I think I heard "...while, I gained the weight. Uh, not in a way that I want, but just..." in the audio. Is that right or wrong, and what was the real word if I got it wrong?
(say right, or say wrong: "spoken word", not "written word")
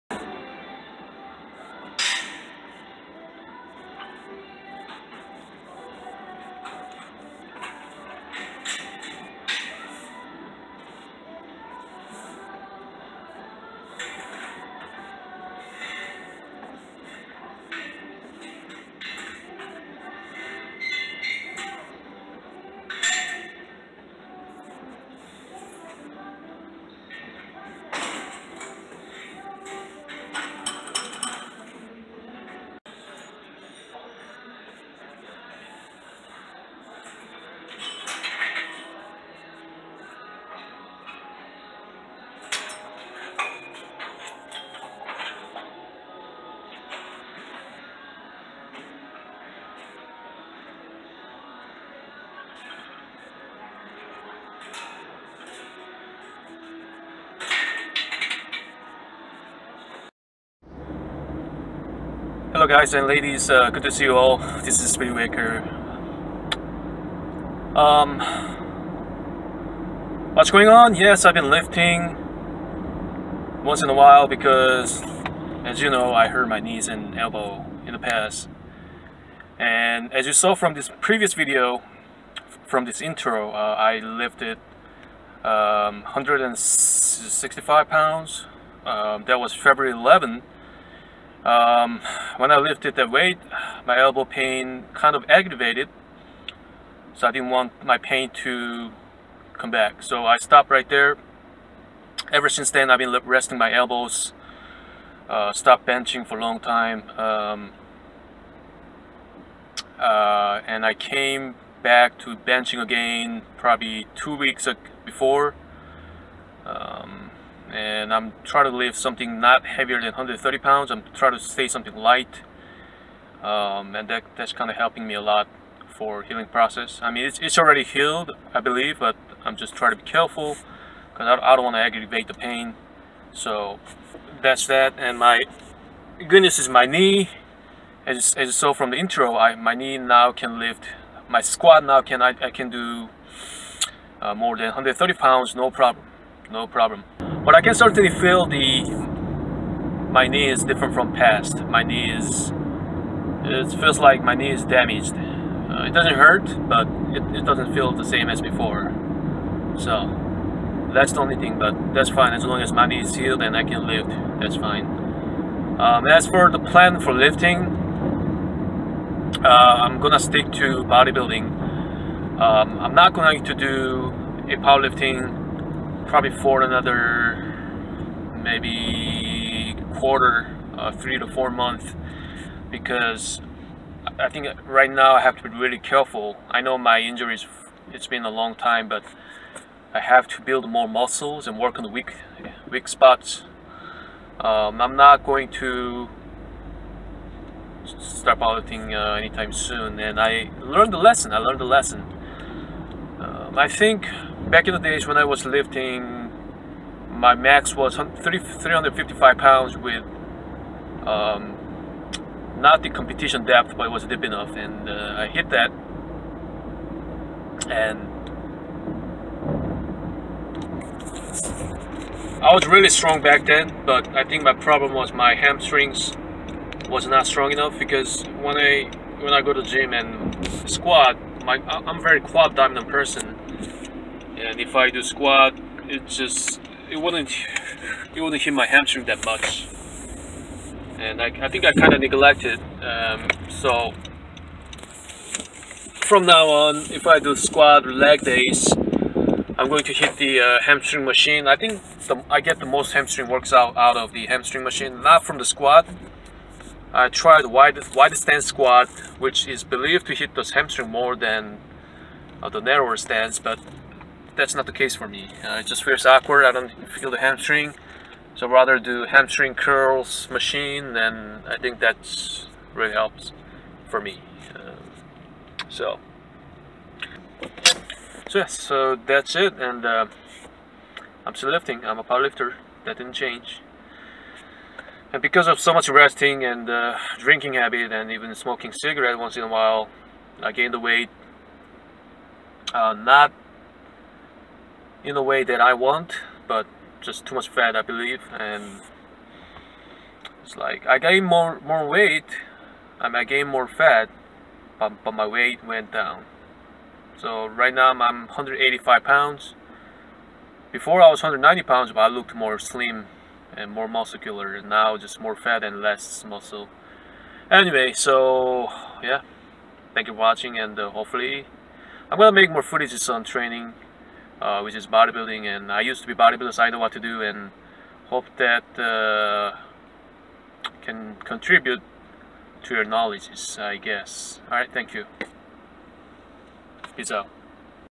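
right.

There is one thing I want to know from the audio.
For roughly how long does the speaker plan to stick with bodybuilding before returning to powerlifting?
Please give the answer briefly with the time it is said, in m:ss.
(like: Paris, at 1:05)
3 to 4 months, at 3:00.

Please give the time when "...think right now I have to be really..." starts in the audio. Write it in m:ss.
3:04.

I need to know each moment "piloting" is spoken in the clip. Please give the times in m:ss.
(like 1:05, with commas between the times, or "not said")
3:18.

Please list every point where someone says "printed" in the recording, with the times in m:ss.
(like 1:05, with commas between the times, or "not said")
not said.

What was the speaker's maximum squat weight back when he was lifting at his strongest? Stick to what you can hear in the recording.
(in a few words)
355 pounds.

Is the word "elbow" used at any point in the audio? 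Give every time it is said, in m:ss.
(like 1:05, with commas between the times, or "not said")
1:17, 1:33, 1:43.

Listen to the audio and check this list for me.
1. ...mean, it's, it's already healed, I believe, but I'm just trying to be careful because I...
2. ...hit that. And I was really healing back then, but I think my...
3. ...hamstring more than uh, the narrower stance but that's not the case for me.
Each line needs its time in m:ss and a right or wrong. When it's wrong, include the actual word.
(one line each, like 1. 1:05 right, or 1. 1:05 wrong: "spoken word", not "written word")
1. 2:07 right
2. 3:35 wrong: "strong", not "healing"
3. 4:20 right.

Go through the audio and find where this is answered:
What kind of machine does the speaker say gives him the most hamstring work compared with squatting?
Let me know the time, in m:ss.
4:29.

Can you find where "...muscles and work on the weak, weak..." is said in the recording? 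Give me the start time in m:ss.
3:10.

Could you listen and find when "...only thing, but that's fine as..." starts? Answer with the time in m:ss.
2:41.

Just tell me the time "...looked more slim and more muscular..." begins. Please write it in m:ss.
5:12.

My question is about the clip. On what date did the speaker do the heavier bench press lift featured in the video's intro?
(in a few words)
February 11th.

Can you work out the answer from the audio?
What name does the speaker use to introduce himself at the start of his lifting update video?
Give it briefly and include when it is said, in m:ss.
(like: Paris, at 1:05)
SpiritWaker, at 1:04.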